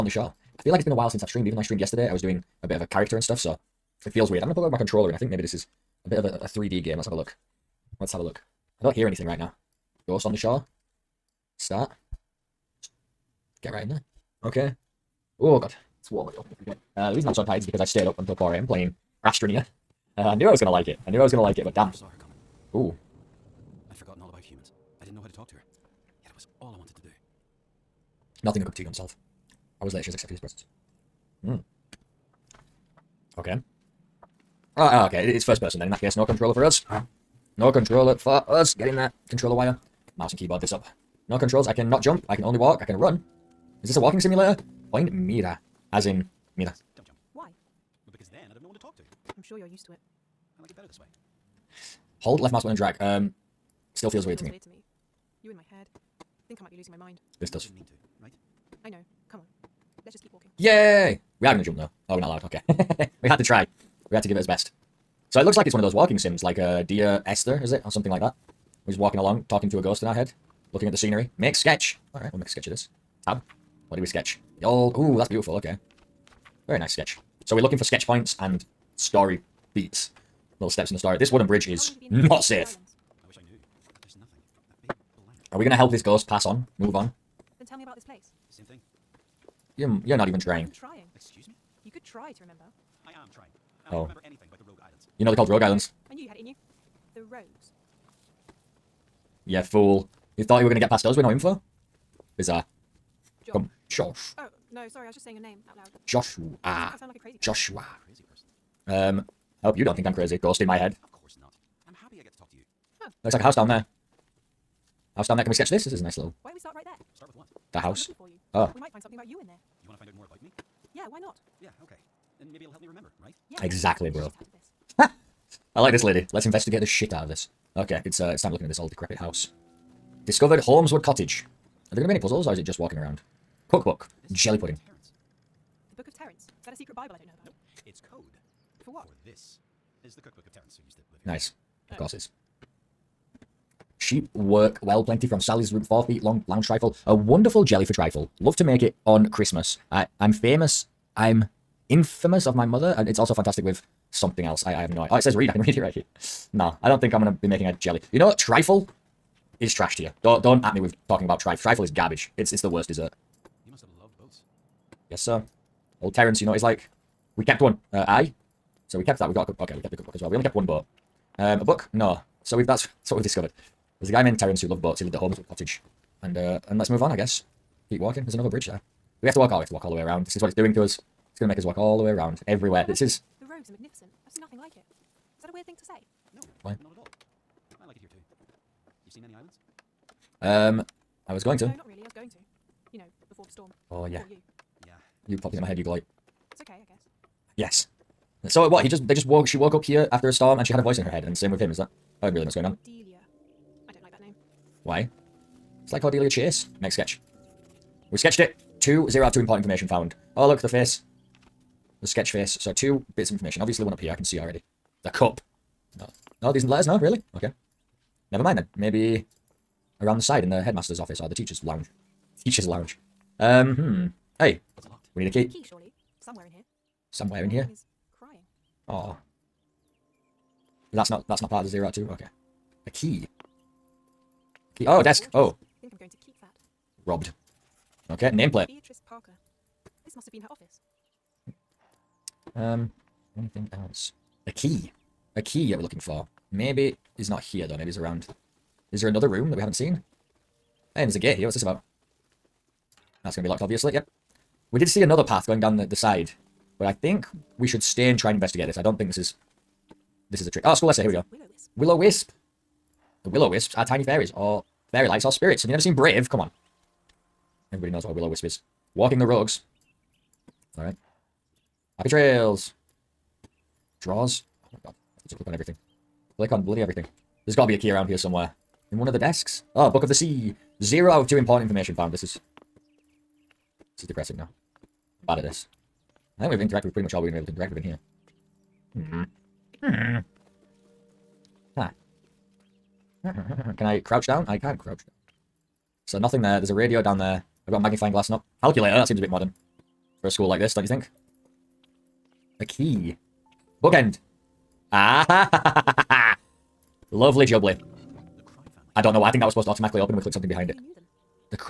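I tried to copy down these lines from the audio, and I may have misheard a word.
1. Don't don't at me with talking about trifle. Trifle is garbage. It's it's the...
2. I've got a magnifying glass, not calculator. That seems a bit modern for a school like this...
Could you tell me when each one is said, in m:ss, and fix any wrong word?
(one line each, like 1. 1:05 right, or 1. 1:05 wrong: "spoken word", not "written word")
1. 2:40 right
2. 4:57 right.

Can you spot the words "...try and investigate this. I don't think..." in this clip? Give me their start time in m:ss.
4:18.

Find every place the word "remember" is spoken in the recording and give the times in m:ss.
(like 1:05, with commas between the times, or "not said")
1:32, 2:02.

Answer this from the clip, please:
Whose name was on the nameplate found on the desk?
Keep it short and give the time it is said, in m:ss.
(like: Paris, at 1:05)
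Beatrice Parker, at 3:58.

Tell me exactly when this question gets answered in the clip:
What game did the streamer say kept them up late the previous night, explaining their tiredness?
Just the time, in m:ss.
0:19.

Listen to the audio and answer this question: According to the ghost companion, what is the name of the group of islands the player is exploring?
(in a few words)
Rogue Islands.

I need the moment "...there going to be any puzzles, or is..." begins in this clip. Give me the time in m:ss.
2:11.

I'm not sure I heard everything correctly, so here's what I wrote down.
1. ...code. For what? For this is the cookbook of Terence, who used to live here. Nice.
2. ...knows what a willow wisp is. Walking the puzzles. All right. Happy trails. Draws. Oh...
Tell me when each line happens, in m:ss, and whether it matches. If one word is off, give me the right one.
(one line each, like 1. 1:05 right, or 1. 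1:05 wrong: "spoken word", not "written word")
1. 2:18 right
2. 4:27 wrong: "rogues", not "puzzles".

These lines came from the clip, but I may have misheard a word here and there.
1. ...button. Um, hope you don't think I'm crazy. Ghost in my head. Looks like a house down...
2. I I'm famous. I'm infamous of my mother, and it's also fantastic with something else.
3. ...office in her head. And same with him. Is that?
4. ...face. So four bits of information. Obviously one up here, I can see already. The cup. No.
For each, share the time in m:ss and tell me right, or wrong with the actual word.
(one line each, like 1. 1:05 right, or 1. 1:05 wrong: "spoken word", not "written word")
1. 1:48 wrong: "person", not "button"
2. 2:29 right
3. 3:20 wrong: "voice", not "office"
4. 3:32 wrong: "two", not "four".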